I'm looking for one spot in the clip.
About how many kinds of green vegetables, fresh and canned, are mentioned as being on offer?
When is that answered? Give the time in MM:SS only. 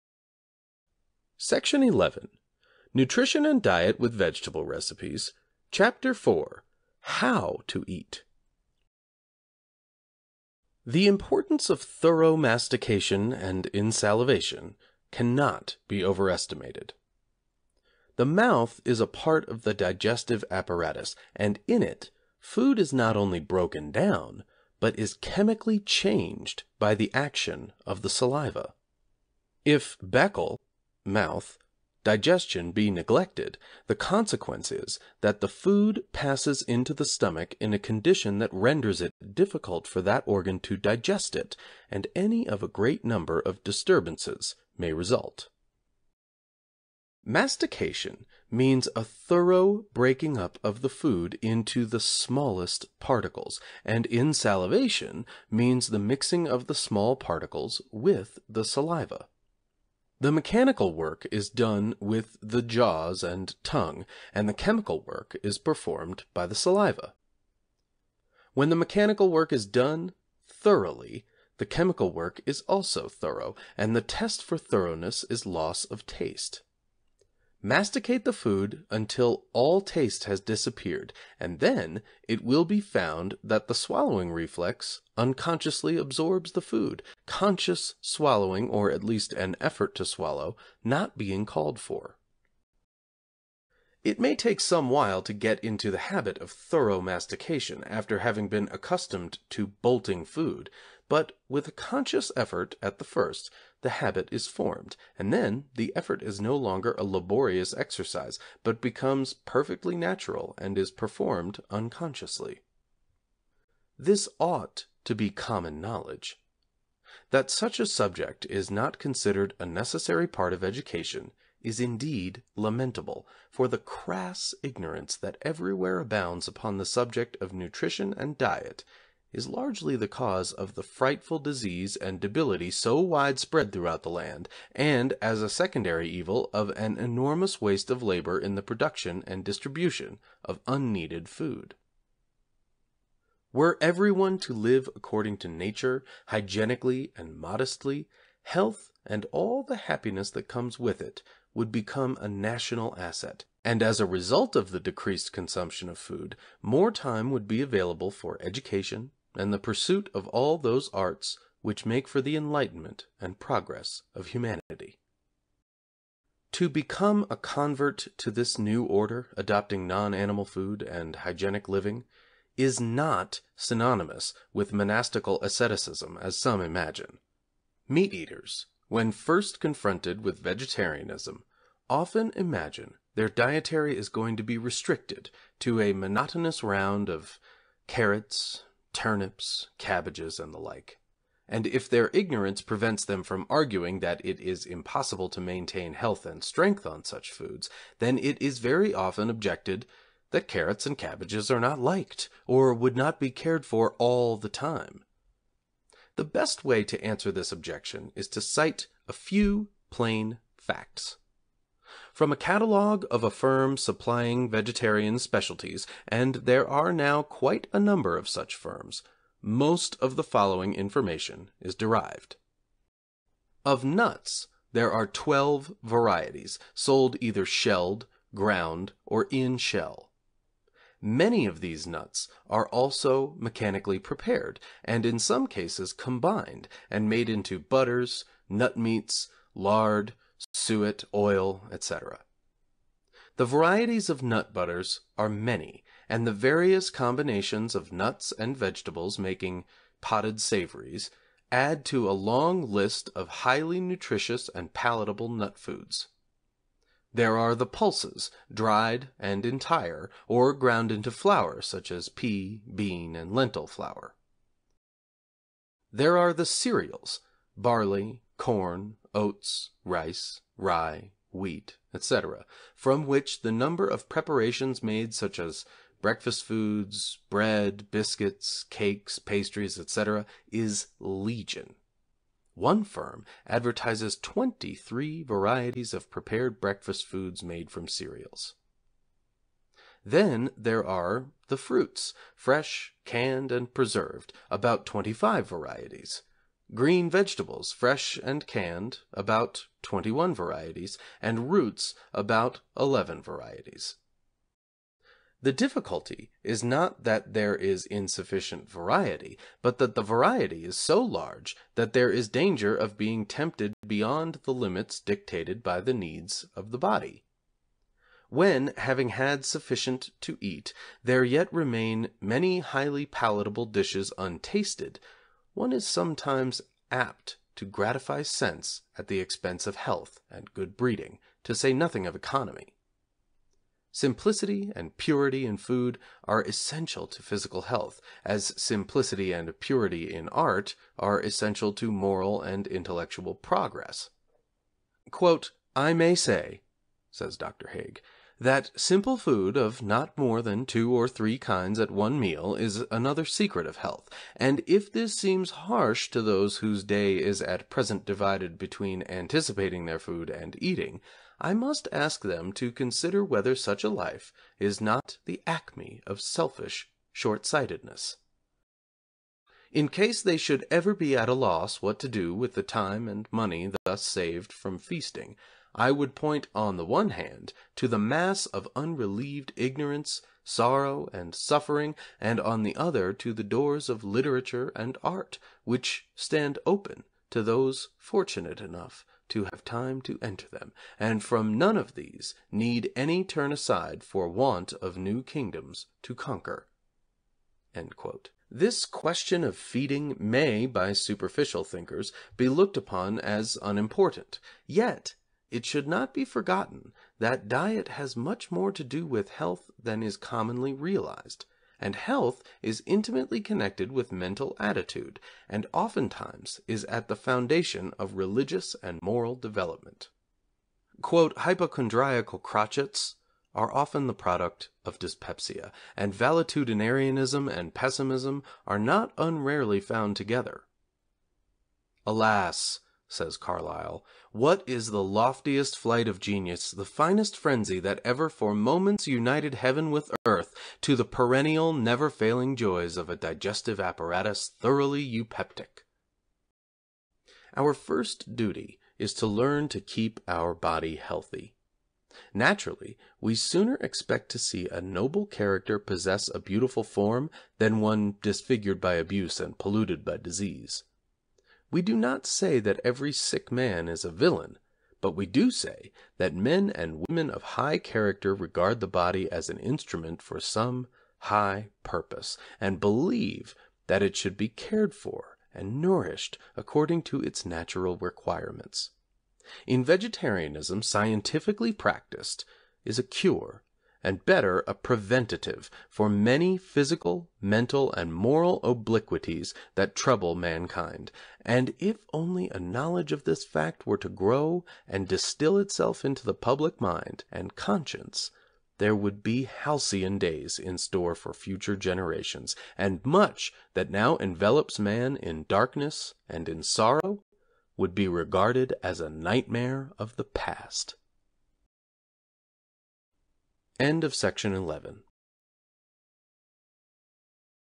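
04:59.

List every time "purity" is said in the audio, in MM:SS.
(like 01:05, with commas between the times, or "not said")
05:34, 05:39.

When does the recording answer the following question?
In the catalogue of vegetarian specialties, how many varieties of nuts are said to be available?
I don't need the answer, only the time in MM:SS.
03:45.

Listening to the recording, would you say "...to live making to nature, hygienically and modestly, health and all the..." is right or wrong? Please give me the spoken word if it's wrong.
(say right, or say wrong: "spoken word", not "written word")
wrong: "according", not "making".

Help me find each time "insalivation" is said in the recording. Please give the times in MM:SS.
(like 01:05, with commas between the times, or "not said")
00:13, 00:54.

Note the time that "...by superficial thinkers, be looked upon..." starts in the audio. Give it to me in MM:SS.
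06:40.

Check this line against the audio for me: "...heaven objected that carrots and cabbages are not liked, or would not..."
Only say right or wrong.
wrong.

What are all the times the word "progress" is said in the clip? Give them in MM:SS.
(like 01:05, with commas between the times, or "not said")
02:43, 05:43.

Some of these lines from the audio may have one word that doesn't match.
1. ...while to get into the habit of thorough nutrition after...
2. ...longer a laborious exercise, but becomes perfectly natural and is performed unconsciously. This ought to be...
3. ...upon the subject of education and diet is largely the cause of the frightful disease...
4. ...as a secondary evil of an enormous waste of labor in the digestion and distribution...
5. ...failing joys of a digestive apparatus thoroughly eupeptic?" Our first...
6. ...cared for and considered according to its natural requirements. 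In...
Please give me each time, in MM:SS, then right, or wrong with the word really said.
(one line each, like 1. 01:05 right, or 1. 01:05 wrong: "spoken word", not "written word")
1. 01:34 wrong: "mastication", not "nutrition"
2. 01:46 right
3. 02:06 wrong: "nutrition", not "education"
4. 02:15 wrong: "production", not "digestion"
5. 07:22 right
6. 07:54 wrong: "nourished", not "considered".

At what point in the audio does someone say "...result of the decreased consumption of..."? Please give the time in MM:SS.
02:34.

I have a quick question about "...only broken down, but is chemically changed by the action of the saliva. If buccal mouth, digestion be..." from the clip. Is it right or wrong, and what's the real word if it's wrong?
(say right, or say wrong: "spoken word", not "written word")
right.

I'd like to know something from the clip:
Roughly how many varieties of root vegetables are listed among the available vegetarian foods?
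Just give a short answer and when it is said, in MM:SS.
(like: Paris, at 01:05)
11, at 05:02.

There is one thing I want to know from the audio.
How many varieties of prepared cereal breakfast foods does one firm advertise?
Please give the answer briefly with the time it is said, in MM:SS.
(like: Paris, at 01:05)
23, at 04:44.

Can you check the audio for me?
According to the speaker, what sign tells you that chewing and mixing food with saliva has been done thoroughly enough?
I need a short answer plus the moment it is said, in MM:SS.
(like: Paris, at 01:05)
Loss of taste, at 01:15.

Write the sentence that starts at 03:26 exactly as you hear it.
The best way to answer this objection is to cite a few plain facts.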